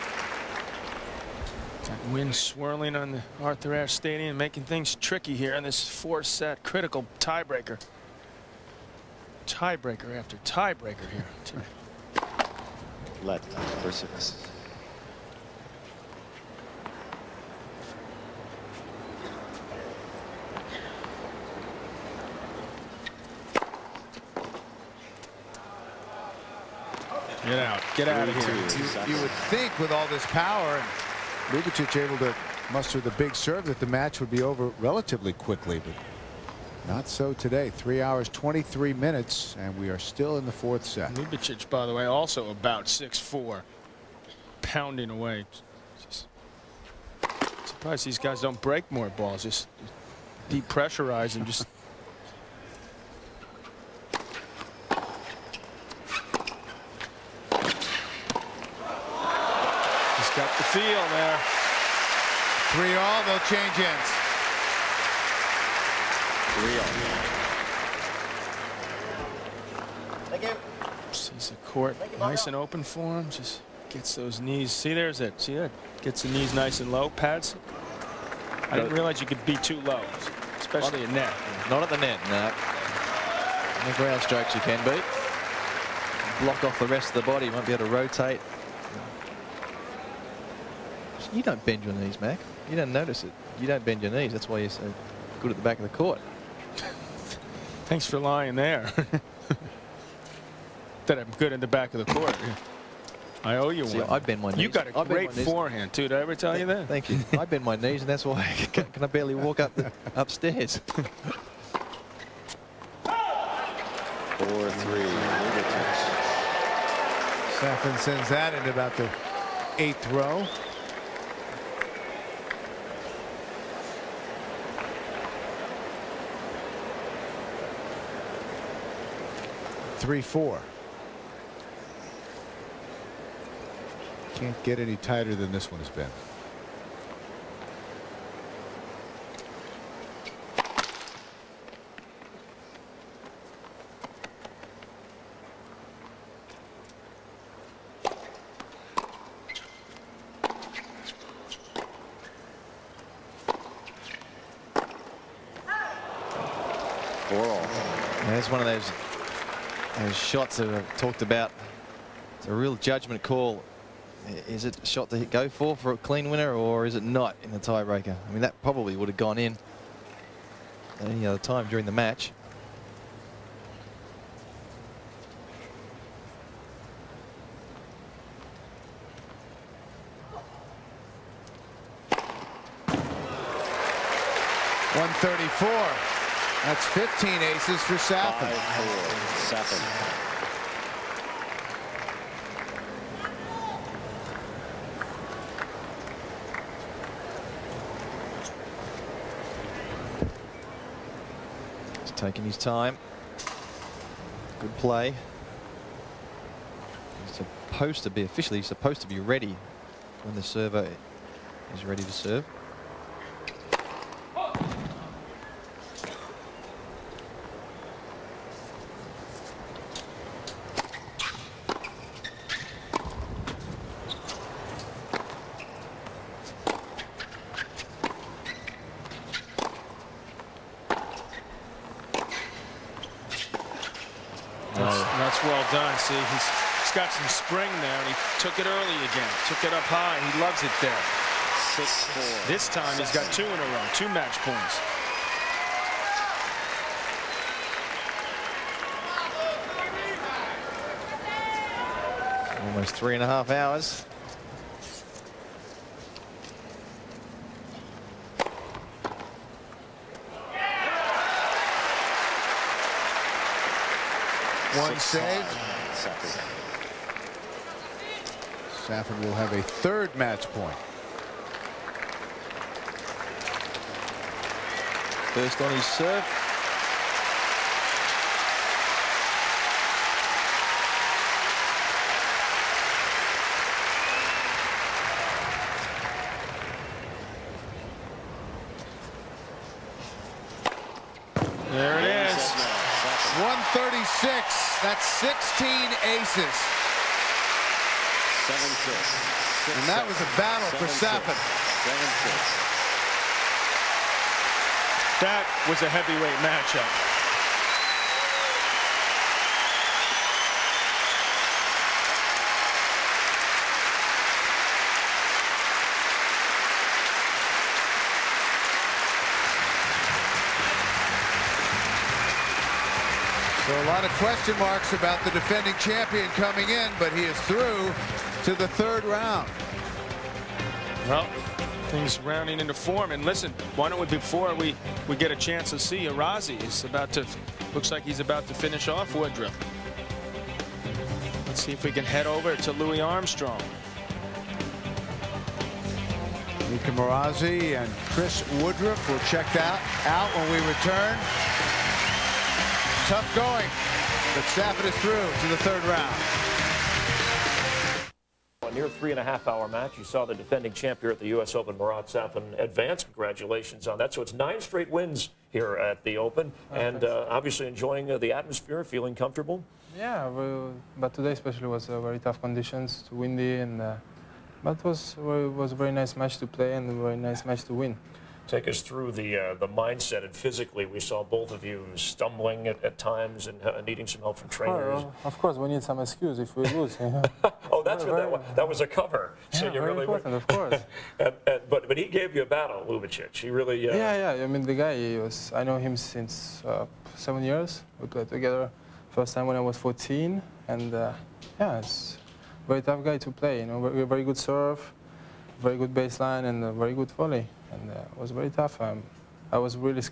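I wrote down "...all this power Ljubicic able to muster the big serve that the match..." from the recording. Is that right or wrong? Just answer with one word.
right.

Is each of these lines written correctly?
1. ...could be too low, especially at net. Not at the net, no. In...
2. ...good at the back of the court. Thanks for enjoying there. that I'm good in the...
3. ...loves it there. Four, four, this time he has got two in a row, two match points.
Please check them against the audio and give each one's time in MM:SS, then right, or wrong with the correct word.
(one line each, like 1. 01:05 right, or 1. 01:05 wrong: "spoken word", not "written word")
1. 01:19 right
2. 01:35 wrong: "lying", not "enjoying"
3. 04:00 wrong: "Six", not "Four".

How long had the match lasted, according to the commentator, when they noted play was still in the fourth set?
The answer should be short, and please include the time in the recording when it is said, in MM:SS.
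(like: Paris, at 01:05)
3 hours 23 minutes, at 00:37.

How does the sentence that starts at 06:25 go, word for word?
Oh, of course, we need some excuse if we lose.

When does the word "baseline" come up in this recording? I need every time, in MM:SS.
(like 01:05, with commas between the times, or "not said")
06:45.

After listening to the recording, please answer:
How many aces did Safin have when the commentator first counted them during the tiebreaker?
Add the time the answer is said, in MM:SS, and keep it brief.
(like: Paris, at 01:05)
15, at 03:06.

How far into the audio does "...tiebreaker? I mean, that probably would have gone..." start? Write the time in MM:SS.
02:47.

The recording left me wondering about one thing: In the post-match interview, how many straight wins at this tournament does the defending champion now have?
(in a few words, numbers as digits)
9.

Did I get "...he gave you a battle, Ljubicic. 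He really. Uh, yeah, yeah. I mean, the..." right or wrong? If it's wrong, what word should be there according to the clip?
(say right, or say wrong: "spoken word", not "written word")
right.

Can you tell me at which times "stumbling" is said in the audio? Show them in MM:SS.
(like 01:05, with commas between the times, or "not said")
06:21.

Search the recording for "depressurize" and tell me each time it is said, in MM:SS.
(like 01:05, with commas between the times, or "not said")
00:50.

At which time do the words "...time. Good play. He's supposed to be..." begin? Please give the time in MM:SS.
03:22.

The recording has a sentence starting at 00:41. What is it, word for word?
Ljubicic, by the way, also about six-four, pounding away.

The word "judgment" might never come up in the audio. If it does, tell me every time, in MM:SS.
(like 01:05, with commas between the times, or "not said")
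02:42.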